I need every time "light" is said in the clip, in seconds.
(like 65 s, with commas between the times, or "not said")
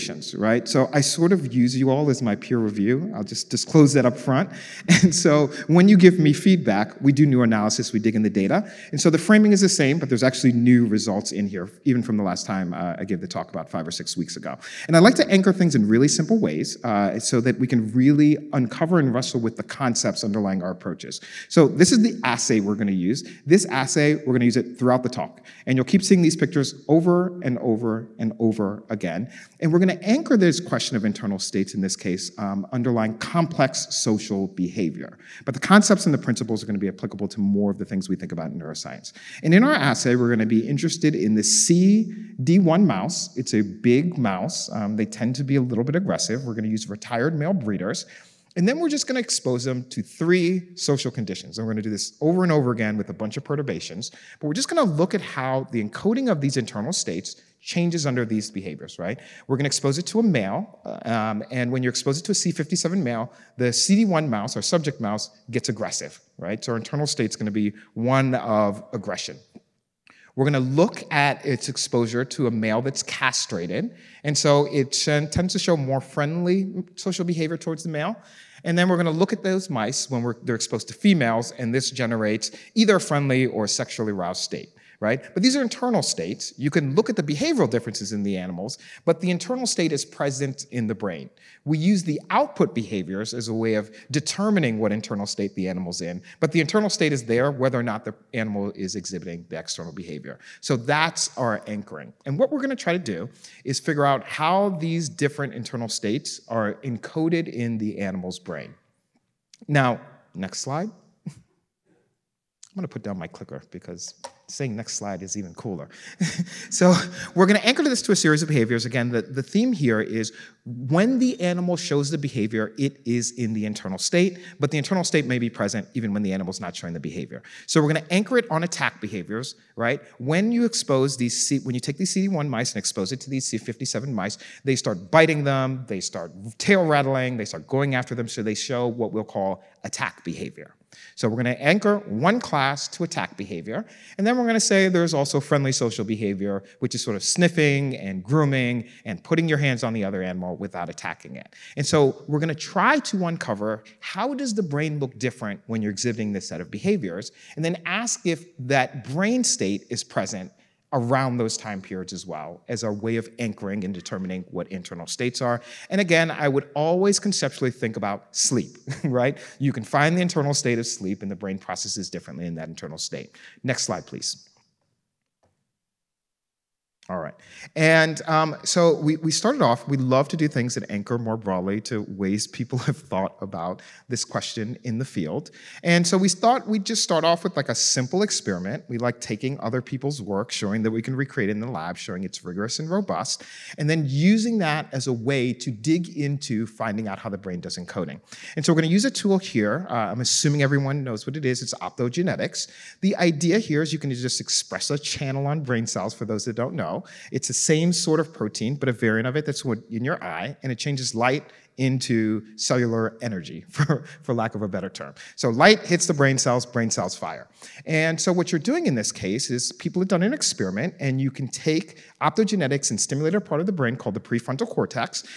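211 s, 215 s.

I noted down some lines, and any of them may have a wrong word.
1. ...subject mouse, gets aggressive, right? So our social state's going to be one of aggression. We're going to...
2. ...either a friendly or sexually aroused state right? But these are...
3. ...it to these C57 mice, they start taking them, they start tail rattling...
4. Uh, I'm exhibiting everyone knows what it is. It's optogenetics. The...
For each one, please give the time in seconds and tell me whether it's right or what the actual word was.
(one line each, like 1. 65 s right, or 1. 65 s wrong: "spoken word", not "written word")
1. 64 s wrong: "internal", not "social"
2. 82 s right
3. 133 s wrong: "biting", not "taking"
4. 199 s wrong: "assuming", not "exhibiting".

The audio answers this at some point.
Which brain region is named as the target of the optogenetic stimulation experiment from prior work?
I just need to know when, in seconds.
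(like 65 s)
224 s.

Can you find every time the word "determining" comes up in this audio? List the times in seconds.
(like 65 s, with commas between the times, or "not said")
94 s, 163 s.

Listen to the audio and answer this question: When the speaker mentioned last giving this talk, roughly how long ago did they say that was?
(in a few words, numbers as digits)
5 or 6 weeks.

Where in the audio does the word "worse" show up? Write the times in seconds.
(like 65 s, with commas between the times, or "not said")
not said.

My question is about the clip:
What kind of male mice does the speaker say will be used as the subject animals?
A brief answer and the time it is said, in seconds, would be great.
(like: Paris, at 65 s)
Retired male breeders, at 46 s.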